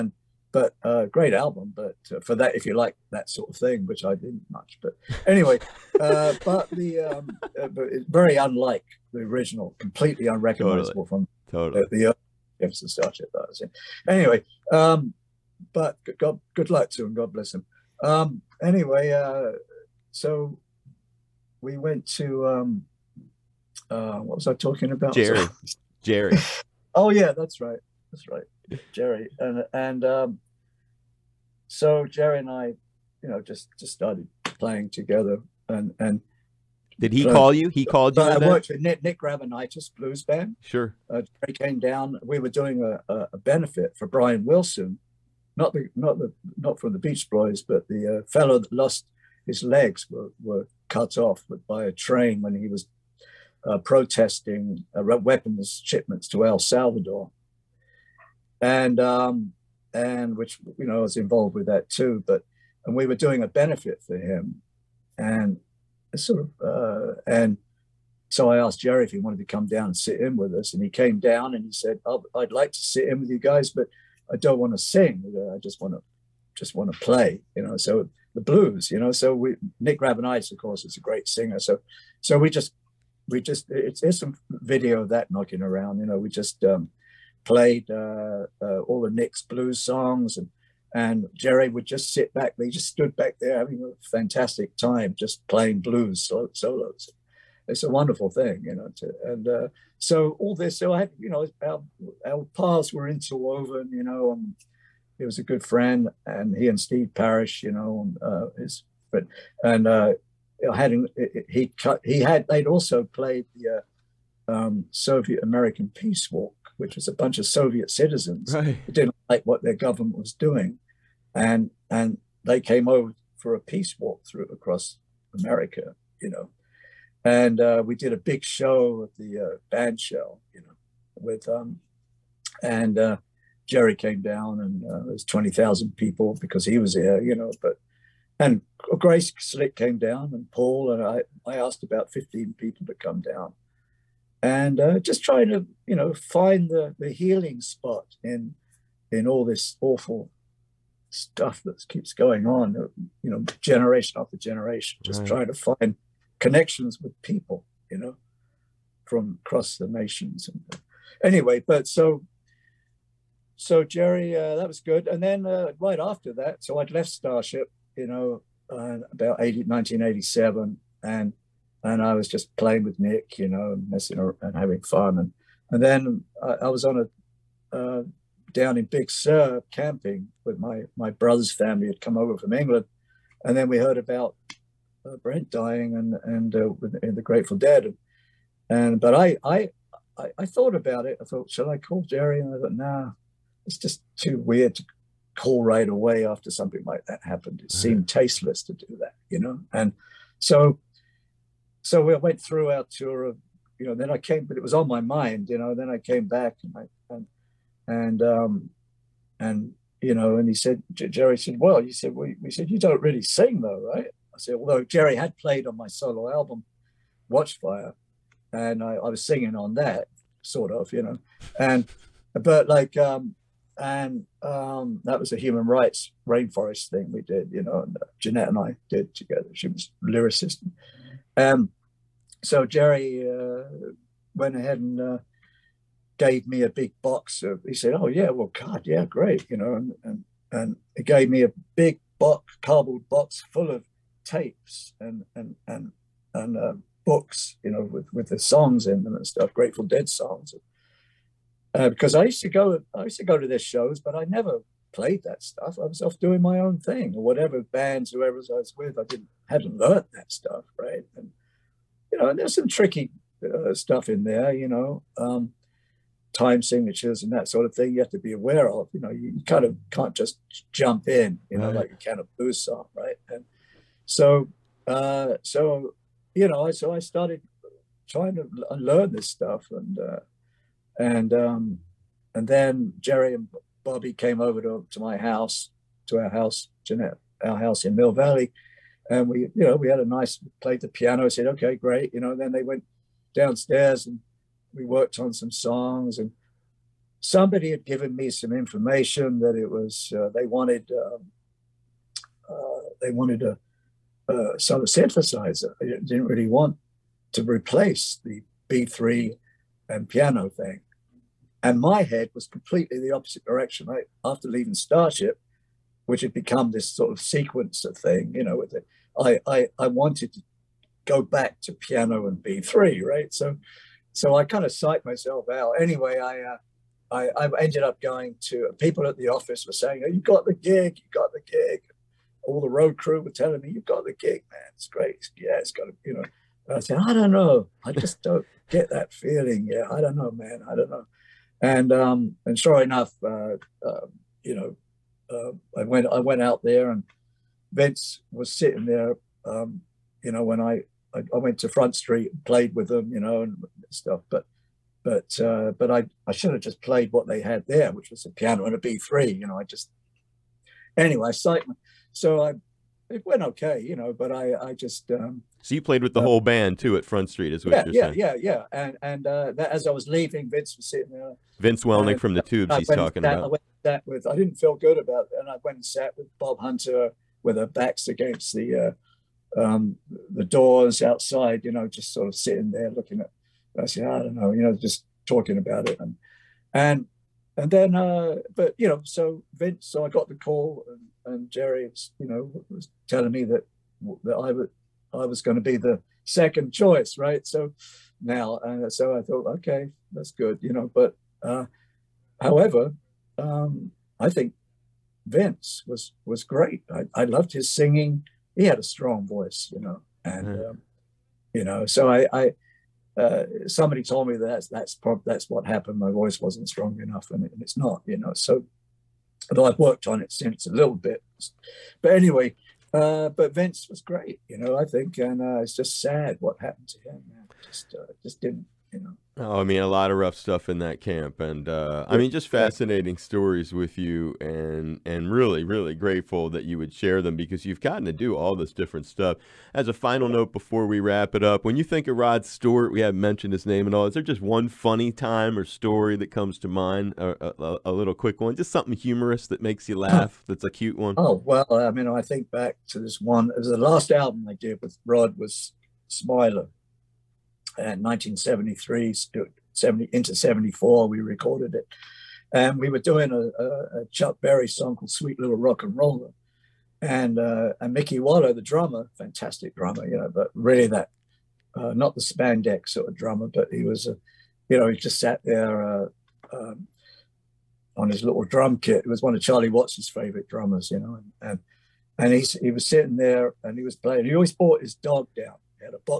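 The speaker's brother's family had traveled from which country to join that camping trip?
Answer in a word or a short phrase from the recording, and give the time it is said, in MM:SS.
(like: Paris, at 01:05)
England, at 03:02.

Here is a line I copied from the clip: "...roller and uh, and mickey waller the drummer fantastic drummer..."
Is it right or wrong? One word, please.
right.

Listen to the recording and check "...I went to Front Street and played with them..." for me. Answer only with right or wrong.
right.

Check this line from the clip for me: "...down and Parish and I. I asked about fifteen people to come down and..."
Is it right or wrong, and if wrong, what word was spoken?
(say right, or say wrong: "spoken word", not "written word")
wrong: "Paul", not "Parish".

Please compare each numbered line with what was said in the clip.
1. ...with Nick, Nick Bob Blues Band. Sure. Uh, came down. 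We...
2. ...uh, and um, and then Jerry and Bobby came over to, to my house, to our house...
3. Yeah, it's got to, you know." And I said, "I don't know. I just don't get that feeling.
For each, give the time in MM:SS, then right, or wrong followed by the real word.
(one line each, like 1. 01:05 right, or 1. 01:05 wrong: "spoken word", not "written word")
1. 00:38 wrong: "Gravenites", not "Bob"
2. 04:39 right
3. 05:35 right.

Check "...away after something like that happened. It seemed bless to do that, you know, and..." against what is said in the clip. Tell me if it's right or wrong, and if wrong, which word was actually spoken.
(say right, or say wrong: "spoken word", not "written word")
wrong: "tasteless", not "bless".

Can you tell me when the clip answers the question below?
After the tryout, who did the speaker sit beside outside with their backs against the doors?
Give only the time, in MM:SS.
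06:16.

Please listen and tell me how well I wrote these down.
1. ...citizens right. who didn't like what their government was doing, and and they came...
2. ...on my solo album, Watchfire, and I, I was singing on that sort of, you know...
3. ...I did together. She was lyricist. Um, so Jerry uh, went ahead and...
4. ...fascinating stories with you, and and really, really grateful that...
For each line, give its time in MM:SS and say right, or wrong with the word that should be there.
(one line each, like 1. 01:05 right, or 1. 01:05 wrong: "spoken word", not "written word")
1. 01:57 right
2. 03:35 right
3. 03:48 right
4. 07:12 right.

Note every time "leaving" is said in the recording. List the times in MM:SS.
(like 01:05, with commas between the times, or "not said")
05:14, 06:10.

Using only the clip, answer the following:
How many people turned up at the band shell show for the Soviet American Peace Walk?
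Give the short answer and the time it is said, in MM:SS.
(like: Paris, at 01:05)
20,000, at 02:15.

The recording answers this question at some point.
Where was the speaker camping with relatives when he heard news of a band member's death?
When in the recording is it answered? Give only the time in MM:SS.
02:58.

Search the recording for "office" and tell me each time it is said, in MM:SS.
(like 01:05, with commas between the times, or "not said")
05:29.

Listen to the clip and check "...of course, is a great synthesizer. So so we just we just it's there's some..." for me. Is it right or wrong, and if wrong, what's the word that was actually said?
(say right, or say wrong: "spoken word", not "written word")
wrong: "singer", not "synthesizer".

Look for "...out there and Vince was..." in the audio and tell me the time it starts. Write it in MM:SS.
05:46.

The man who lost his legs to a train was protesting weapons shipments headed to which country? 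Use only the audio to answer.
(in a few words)
El Salvador.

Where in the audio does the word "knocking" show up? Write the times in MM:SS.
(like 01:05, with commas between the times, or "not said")
01:25.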